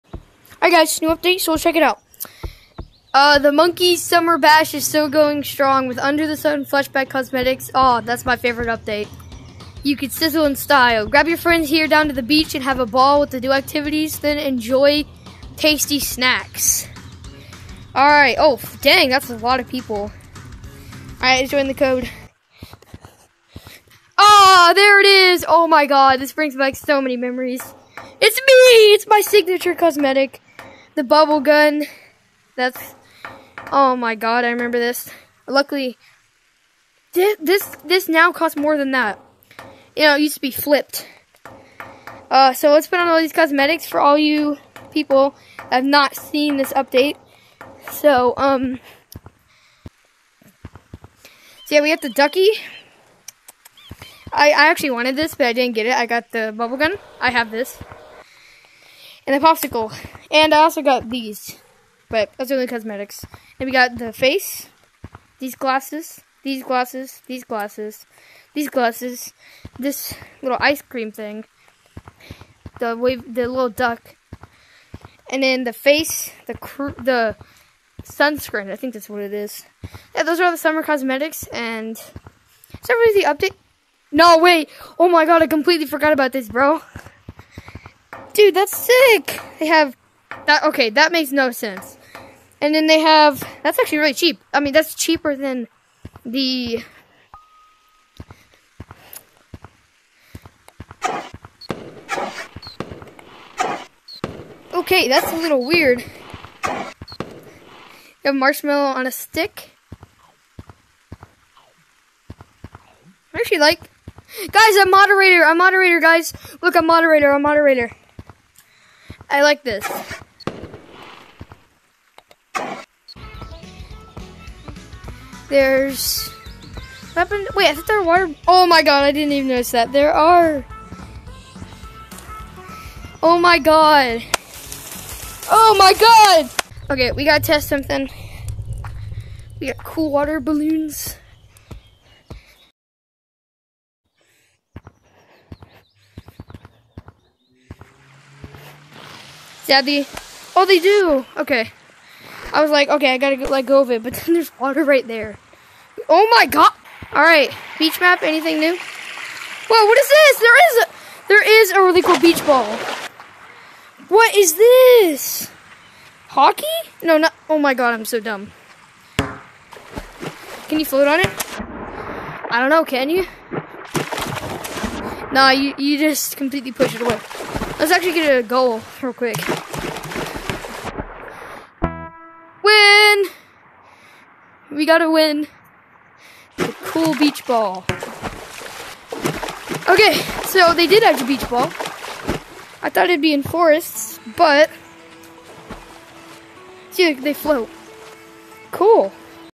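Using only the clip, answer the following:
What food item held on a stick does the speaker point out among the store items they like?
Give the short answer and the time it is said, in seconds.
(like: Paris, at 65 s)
marshmallow, at 108 s.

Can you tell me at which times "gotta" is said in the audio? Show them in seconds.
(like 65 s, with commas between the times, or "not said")
137 s, 153 s, 184 s.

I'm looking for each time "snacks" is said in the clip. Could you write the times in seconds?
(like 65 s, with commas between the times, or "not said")
15 s.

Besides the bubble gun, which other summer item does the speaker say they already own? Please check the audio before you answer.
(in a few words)
popsicle.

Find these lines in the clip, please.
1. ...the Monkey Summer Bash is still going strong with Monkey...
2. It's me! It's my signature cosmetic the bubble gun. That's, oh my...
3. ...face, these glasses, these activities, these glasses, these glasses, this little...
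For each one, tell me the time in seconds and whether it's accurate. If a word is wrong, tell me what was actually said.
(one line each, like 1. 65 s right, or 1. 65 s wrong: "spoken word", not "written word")
1. 3 s wrong: "Under", not "Monkey"
2. 28 s right
3. 64 s wrong: "glasses", not "activities".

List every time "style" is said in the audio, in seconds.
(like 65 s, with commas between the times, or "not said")
10 s.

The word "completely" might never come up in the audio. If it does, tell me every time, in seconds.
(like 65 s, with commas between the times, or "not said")
85 s, 176 s.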